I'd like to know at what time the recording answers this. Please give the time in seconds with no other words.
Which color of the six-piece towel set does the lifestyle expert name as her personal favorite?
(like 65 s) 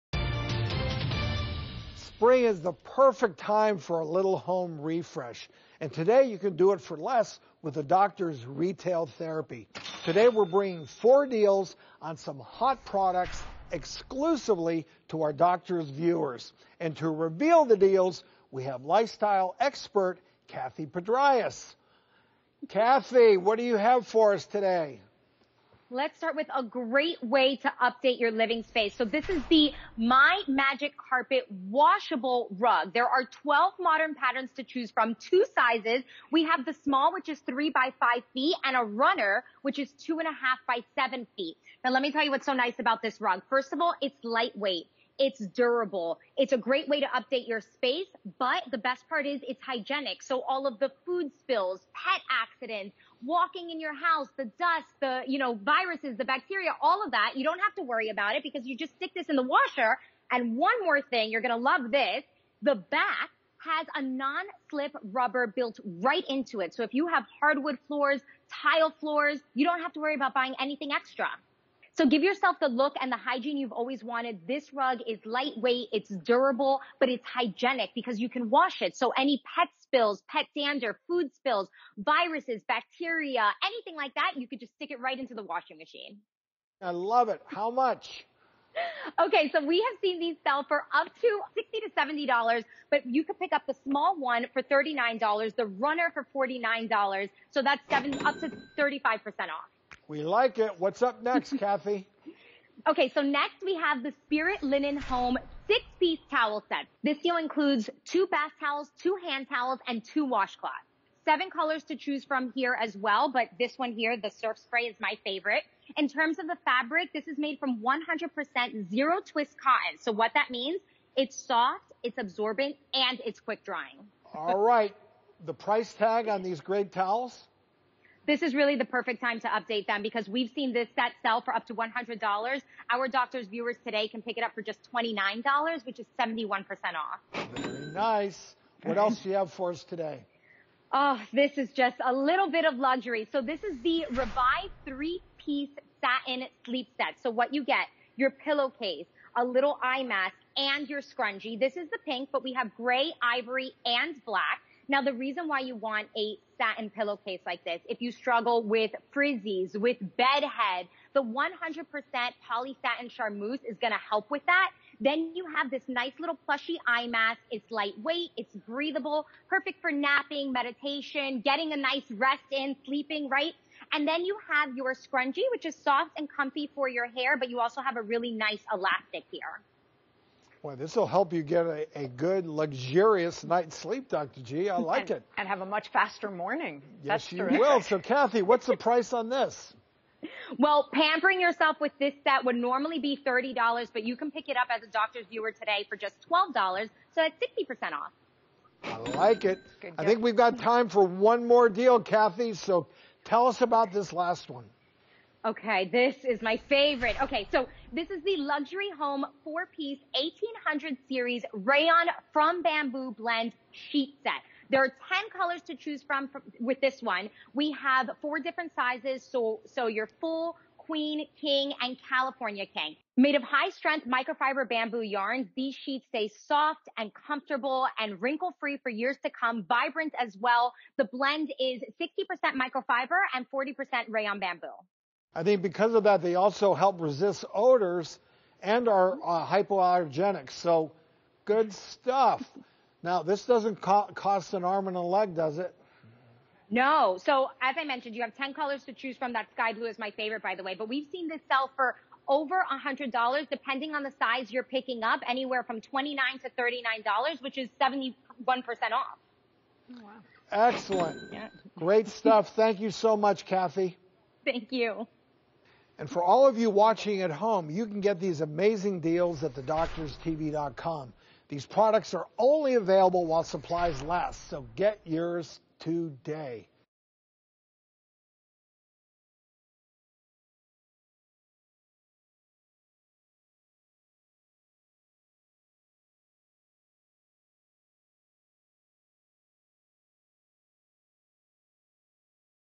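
114 s.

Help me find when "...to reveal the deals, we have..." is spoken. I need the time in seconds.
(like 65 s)
16 s.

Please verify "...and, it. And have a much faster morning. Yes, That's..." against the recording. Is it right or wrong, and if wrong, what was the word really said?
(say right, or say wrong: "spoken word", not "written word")
right.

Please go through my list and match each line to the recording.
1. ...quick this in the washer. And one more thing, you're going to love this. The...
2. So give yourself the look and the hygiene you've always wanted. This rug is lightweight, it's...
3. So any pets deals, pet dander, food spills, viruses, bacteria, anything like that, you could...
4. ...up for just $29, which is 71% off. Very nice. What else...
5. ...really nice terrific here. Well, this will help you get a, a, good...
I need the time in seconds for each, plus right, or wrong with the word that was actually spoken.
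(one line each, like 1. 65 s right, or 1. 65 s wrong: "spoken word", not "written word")
1. 58 s wrong: "stick", not "quick"
2. 71 s right
3. 78 s wrong: "spills", not "deals"
4. 134 s right
5. 178 s wrong: "elastic", not "terrific".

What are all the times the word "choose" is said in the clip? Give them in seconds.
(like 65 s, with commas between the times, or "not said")
34 s, 111 s, 215 s, 248 s.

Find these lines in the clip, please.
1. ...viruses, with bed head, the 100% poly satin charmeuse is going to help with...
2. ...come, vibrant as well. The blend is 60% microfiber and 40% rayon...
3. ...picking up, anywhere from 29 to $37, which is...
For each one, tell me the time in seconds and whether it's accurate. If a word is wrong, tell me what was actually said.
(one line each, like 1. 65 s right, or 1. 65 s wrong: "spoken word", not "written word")
1. 159 s wrong: "frizzies", not "viruses"
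2. 229 s right
3. 254 s wrong: "39", not "37".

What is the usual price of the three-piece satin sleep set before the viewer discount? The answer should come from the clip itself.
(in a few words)
$30.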